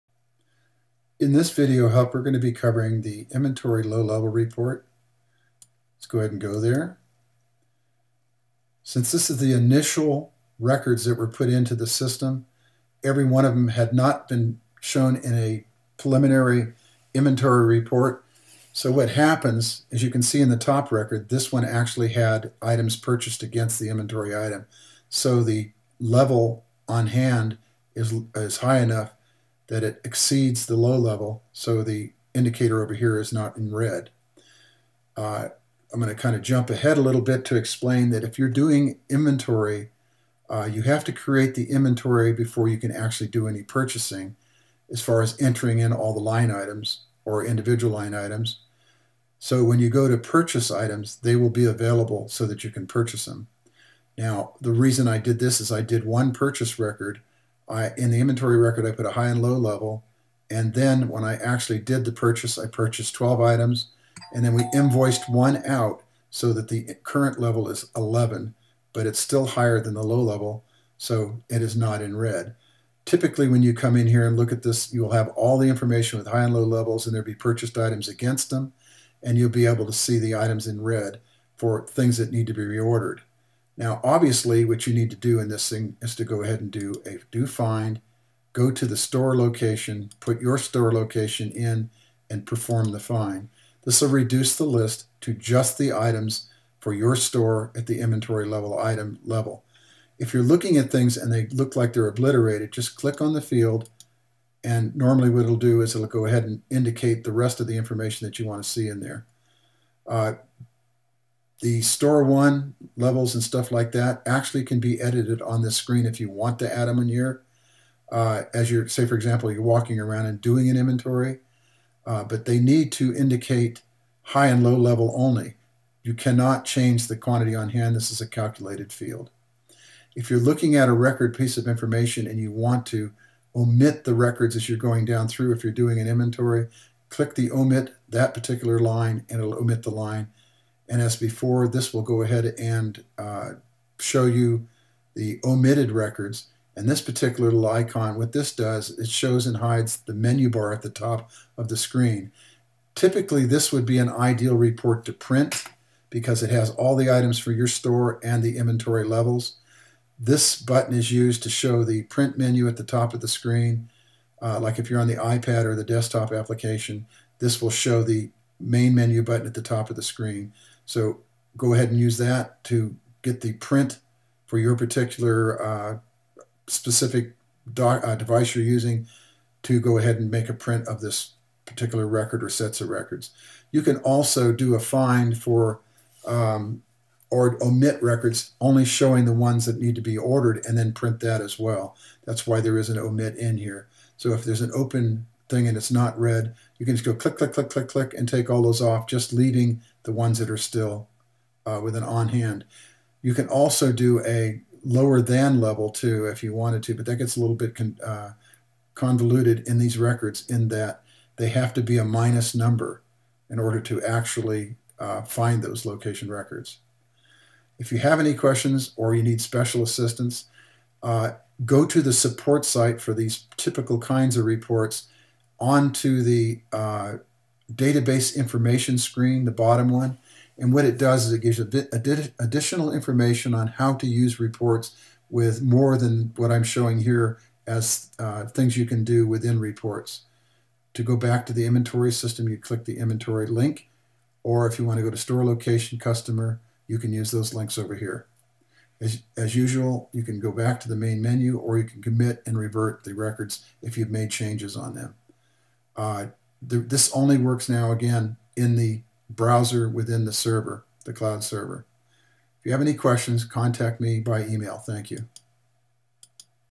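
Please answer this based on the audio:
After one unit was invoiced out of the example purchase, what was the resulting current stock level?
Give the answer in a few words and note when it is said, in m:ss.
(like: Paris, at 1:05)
11, at 1:07.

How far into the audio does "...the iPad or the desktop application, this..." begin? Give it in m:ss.
2:45.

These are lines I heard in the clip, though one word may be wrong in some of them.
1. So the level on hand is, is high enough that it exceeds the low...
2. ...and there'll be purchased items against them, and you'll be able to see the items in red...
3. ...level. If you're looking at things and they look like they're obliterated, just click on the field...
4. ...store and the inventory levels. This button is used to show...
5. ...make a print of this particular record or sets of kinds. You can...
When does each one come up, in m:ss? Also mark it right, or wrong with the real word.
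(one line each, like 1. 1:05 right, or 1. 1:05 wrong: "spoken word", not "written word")
1. 0:25 right
2. 1:17 right
3. 1:39 right
4. 2:37 right
5. 3:00 wrong: "records", not "kinds".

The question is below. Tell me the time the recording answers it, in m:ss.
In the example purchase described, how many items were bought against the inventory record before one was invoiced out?
1:03.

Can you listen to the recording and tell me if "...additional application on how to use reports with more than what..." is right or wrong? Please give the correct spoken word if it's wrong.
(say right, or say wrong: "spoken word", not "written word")
wrong: "information", not "application".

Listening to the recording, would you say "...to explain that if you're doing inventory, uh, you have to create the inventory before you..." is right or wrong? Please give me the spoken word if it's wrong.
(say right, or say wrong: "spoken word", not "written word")
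right.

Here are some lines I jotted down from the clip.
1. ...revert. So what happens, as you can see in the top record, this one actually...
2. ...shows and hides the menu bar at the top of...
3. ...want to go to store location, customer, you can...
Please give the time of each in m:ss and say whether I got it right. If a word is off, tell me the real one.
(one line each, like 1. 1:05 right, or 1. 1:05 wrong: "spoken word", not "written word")
1. 0:17 wrong: "report", not "revert"
2. 2:29 right
3. 4:04 right.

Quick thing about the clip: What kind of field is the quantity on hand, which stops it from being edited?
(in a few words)
Calculated field.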